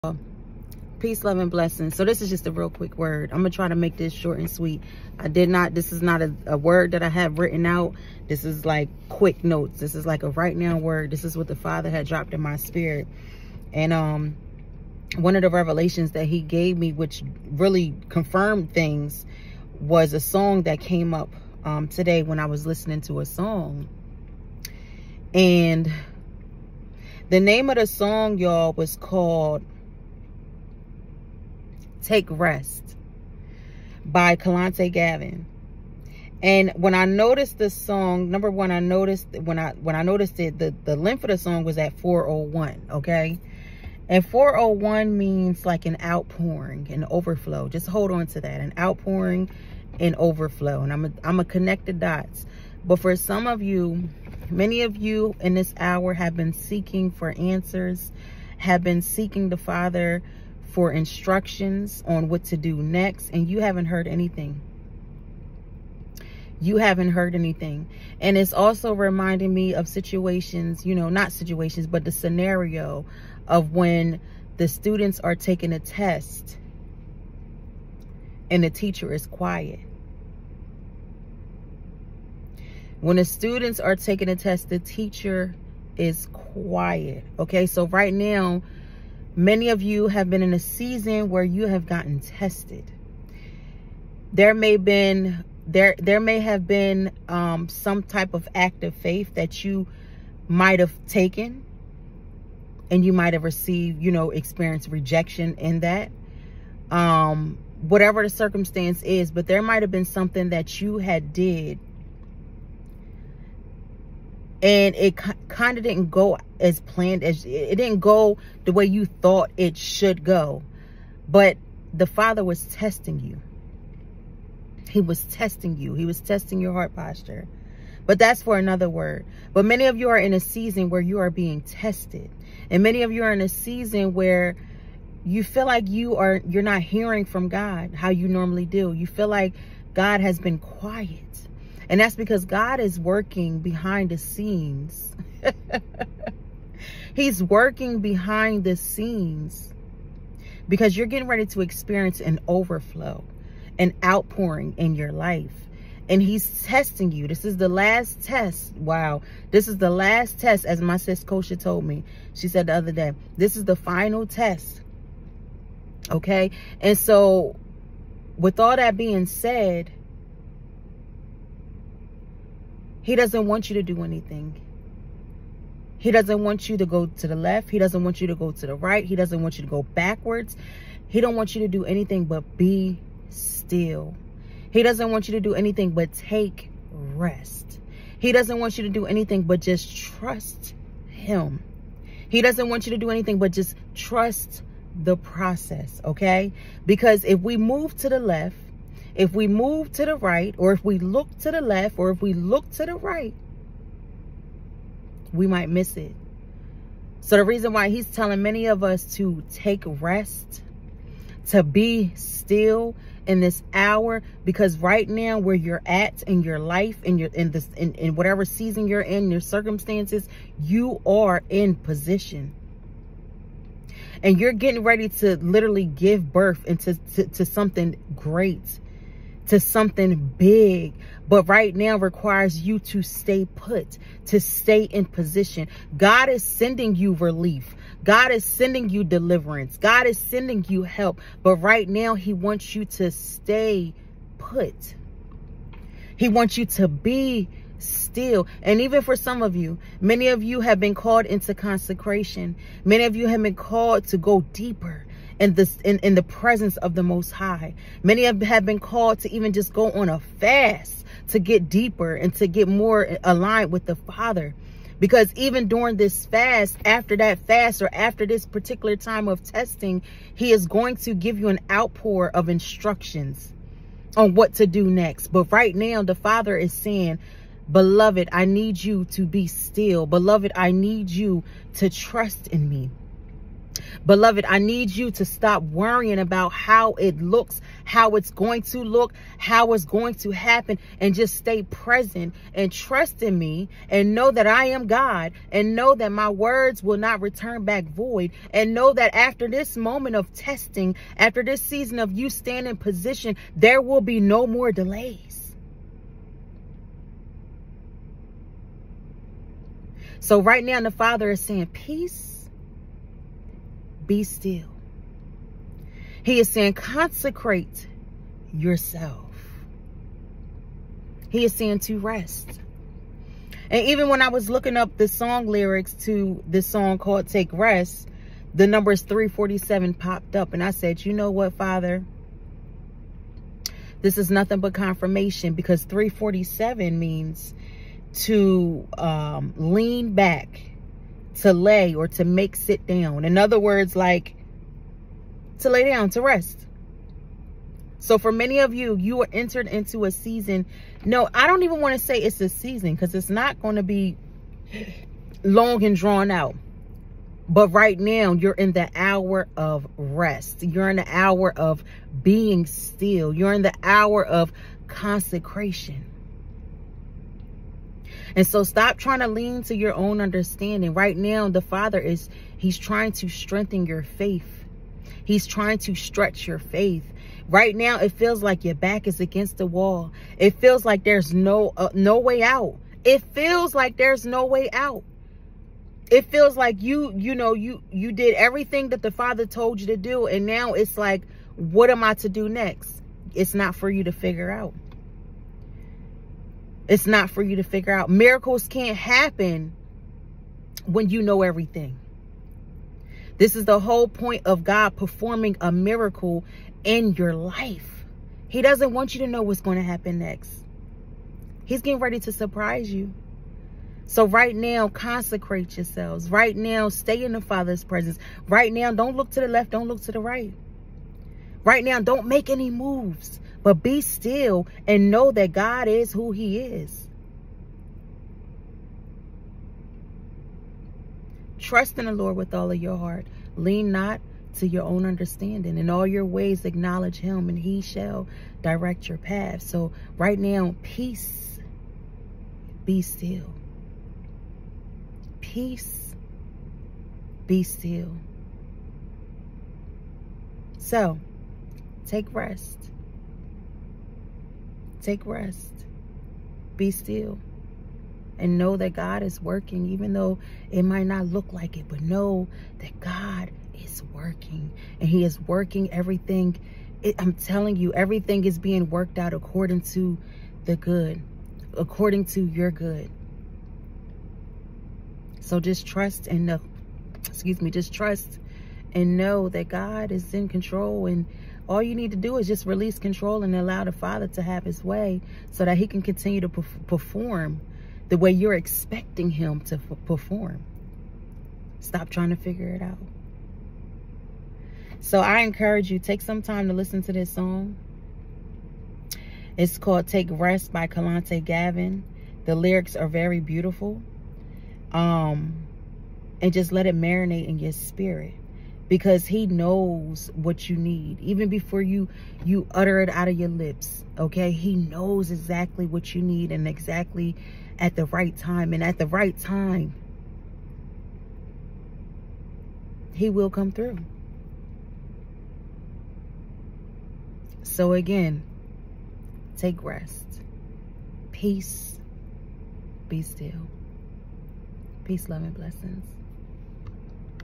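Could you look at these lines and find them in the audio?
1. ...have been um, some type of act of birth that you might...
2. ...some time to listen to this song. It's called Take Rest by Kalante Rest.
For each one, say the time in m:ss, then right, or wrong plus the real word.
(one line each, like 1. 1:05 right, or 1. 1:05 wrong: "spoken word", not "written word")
1. 1:36 wrong: "faith", not "birth"
2. 8:16 wrong: "Gavin", not "Rest".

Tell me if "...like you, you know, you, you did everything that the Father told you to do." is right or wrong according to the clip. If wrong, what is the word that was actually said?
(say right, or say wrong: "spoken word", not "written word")
right.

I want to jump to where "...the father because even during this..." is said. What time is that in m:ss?
4:23.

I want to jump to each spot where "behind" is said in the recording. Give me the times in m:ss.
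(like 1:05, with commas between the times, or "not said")
2:23, 2:27.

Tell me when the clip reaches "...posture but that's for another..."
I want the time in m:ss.
2:06.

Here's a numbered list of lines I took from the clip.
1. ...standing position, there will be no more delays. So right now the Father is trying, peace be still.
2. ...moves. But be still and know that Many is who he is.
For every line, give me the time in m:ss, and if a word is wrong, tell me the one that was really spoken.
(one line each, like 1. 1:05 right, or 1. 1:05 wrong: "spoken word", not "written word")
1. 5:02 wrong: "saying", not "trying"
2. 7:02 wrong: "God", not "Many".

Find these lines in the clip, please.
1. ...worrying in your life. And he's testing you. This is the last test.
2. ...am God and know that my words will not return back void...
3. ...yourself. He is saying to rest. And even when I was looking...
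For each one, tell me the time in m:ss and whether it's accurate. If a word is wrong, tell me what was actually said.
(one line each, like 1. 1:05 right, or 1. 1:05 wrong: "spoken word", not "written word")
1. 2:34 wrong: "outpouring", not "worrying"
2. 4:54 right
3. 5:18 right.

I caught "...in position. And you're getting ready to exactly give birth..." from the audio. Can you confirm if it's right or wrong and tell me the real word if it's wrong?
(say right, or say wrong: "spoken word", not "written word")
wrong: "literally", not "exactly".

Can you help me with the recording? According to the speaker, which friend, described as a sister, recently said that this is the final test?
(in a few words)
Kosha.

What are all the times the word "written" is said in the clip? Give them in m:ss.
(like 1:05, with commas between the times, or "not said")
0:07.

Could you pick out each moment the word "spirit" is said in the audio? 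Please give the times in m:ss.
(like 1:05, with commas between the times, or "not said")
0:12, 8:27.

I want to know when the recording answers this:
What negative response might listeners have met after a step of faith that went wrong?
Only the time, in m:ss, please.
1:44.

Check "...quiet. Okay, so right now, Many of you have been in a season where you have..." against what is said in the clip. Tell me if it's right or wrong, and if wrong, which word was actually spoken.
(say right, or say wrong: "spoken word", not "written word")
right.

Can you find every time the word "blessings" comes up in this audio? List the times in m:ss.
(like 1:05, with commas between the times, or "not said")
0:01, 8:55.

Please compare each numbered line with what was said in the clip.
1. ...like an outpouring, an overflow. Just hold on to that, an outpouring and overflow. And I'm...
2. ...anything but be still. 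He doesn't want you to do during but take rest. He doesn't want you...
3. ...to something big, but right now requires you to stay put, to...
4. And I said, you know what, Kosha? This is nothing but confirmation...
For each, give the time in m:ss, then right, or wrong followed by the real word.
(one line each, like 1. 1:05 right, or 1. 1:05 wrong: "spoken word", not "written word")
1. 0:45 right
2. 3:01 wrong: "anything", not "during"
3. 3:49 right
4. 5:30 wrong: "Father", not "Kosha".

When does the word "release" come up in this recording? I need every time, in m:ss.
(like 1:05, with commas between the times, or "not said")
8:02.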